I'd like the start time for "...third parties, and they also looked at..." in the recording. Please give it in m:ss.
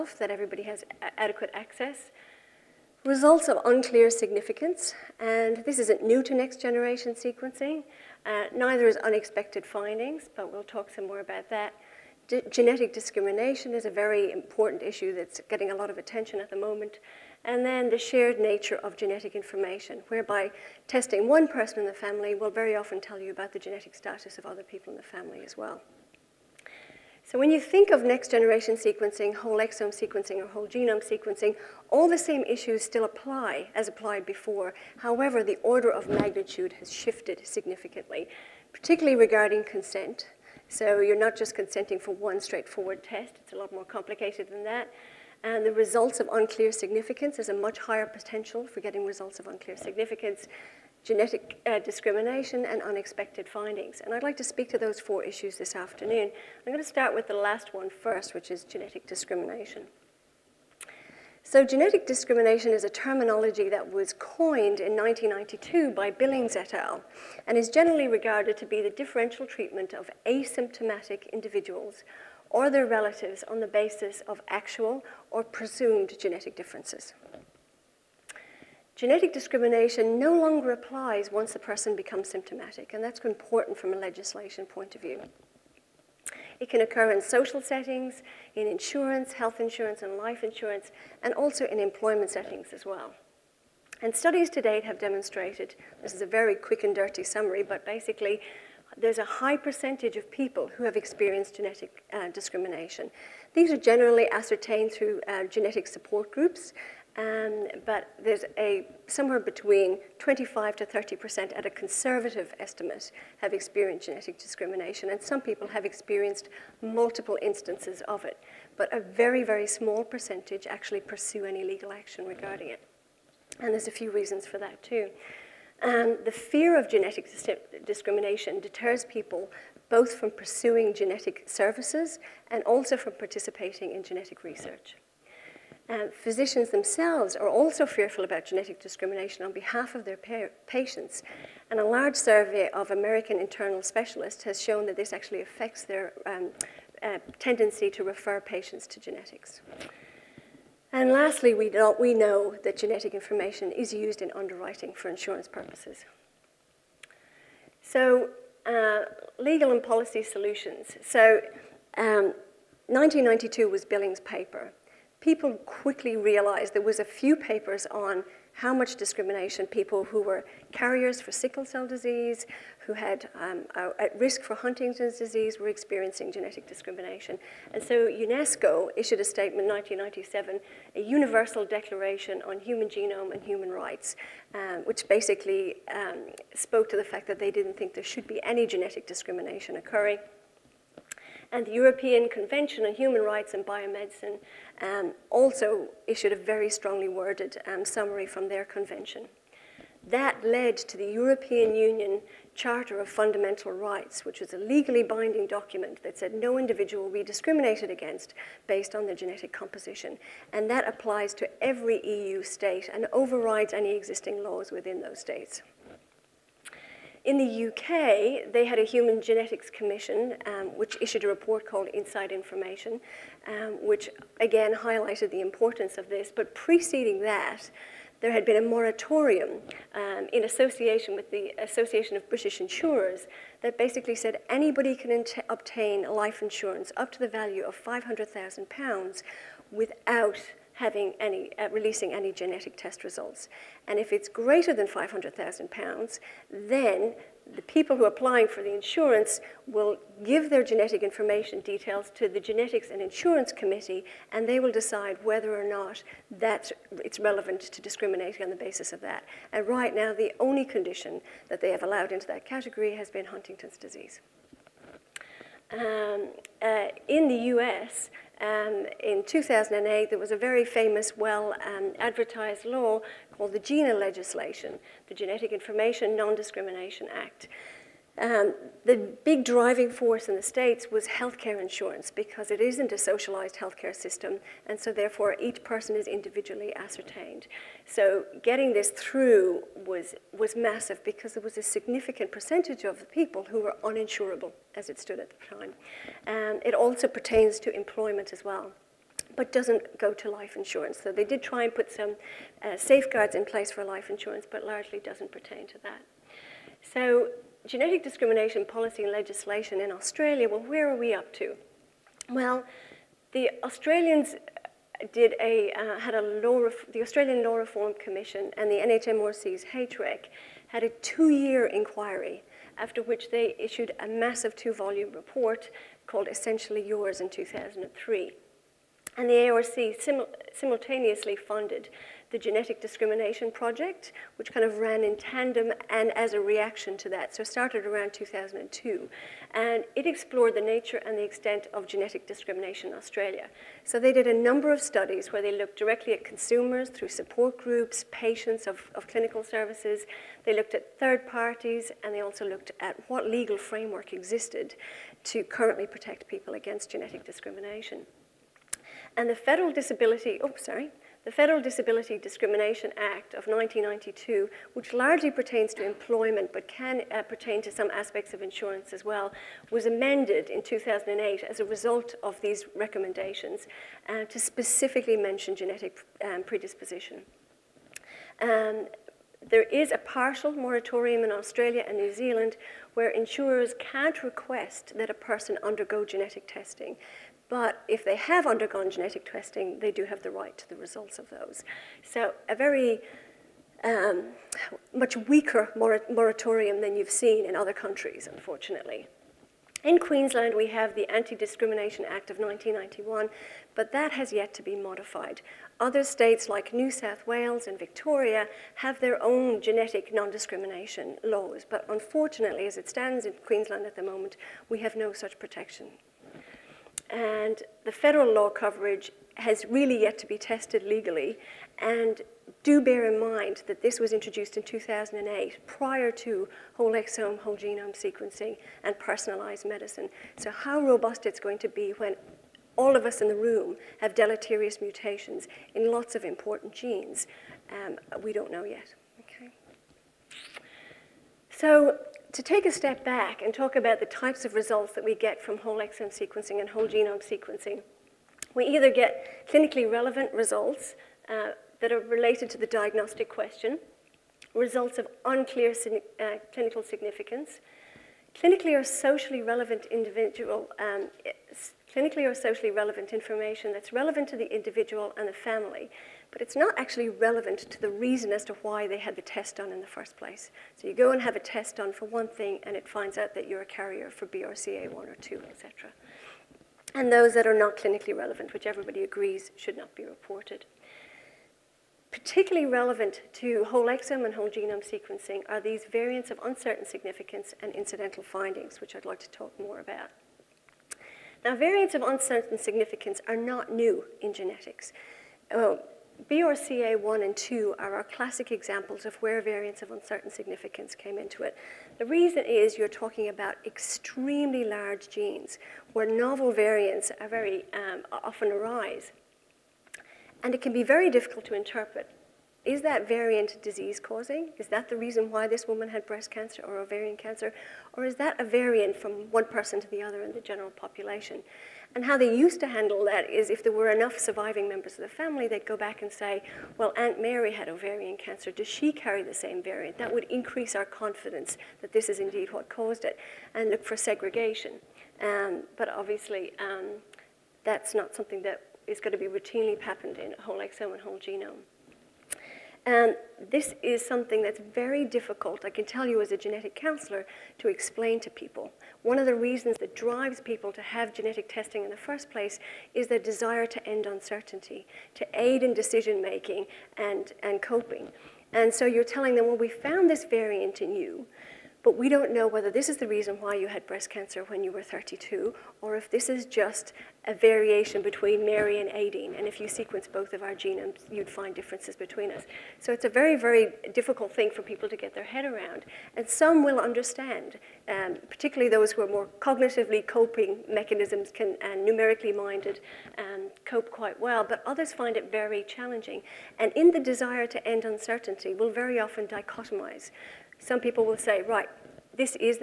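5:50.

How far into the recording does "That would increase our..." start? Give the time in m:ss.
8:49.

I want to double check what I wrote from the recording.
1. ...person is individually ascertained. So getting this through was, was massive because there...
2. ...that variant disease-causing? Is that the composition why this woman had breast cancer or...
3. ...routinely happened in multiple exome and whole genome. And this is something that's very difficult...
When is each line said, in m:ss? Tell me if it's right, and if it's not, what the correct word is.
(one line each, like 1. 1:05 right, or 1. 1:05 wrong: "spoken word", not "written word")
1. 4:45 right
2. 8:32 wrong: "reason", not "composition"
3. 8:59 wrong: "whole", not "multiple".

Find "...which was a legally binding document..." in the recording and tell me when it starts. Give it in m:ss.
3:24.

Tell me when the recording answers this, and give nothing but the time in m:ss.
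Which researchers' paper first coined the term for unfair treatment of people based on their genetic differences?
1:06.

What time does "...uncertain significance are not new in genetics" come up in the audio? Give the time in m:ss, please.
8:12.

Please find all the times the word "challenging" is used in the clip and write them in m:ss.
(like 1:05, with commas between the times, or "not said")
9:45.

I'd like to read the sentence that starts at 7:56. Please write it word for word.
And those that are not clinically relevant, which everybody agrees should not be reported.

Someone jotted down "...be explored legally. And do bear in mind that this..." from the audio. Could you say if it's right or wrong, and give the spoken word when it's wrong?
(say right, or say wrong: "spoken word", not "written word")
wrong: "tested", not "explored".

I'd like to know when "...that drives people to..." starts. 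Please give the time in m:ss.
9:09.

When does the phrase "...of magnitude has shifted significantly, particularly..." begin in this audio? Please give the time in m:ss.
0:35.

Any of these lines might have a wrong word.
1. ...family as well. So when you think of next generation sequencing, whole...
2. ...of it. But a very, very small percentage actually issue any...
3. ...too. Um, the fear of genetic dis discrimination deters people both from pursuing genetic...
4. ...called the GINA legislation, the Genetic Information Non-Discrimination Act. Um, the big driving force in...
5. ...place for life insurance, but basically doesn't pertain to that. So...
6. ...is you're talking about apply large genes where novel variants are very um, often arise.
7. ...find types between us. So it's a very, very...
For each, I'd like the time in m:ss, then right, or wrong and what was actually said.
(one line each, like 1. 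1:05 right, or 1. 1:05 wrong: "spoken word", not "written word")
1. 0:25 right
2. 1:58 wrong: "pursue", not "issue"
3. 2:04 right
4. 4:33 right
5. 5:03 wrong: "largely", not "basically"
6. 8:22 wrong: "extremely", not "apply"
7. 9:31 wrong: "differences", not "types".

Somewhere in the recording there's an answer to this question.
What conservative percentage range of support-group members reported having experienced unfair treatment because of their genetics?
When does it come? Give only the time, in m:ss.
1:50.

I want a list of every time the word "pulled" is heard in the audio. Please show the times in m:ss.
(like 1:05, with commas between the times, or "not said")
not said.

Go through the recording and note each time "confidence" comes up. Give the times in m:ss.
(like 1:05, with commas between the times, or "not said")
8:50.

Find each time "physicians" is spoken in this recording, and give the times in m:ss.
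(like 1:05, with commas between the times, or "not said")
2:16.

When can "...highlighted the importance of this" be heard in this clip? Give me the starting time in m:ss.
3:44.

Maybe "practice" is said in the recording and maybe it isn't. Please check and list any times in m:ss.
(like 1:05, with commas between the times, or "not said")
not said.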